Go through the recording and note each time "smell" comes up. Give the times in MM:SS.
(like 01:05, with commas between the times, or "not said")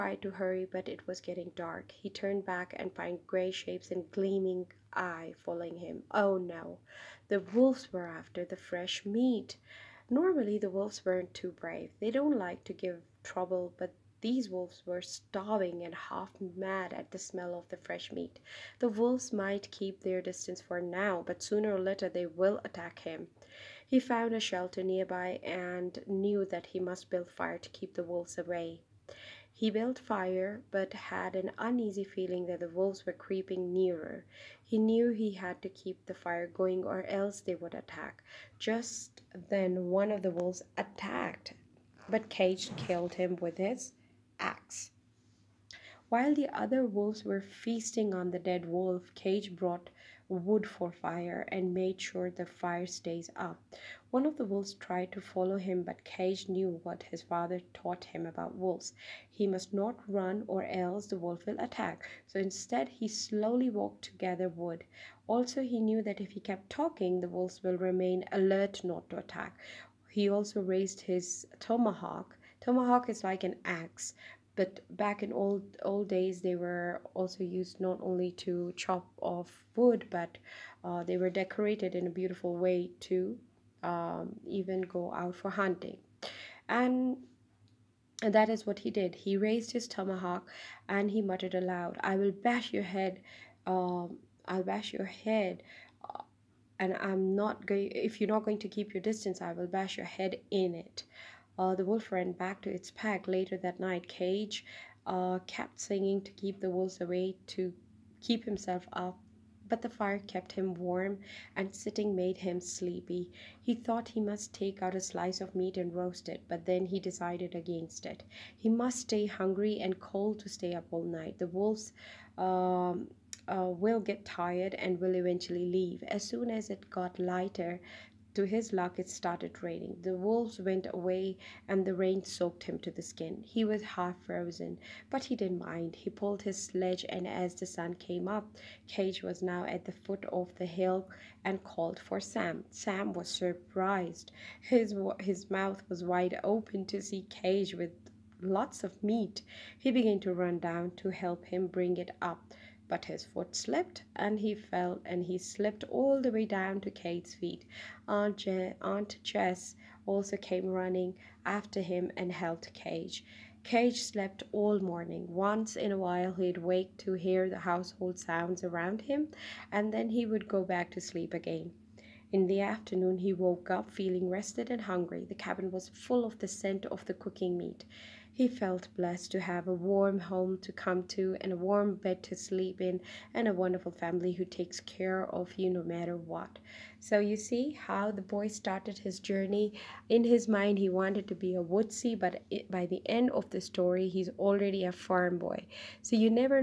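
00:17.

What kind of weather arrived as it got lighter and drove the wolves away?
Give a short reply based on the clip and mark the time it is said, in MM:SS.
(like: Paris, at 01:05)
rain, at 02:09.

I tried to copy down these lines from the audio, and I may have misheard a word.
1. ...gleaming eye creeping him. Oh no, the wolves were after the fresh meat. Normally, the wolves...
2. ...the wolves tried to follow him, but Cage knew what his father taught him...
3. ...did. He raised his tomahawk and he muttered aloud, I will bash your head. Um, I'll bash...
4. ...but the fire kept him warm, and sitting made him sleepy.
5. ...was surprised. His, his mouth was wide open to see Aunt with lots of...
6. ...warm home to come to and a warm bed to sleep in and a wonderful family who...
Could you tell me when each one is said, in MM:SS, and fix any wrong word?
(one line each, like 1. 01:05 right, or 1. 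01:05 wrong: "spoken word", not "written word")
1. 00:04 wrong: "following", not "creeping"
2. 00:54 right
3. 01:28 right
4. 01:49 right
5. 02:23 wrong: "Cage", not "Aunt"
6. 02:59 right.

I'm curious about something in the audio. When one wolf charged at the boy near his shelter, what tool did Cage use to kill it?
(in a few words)
his axe.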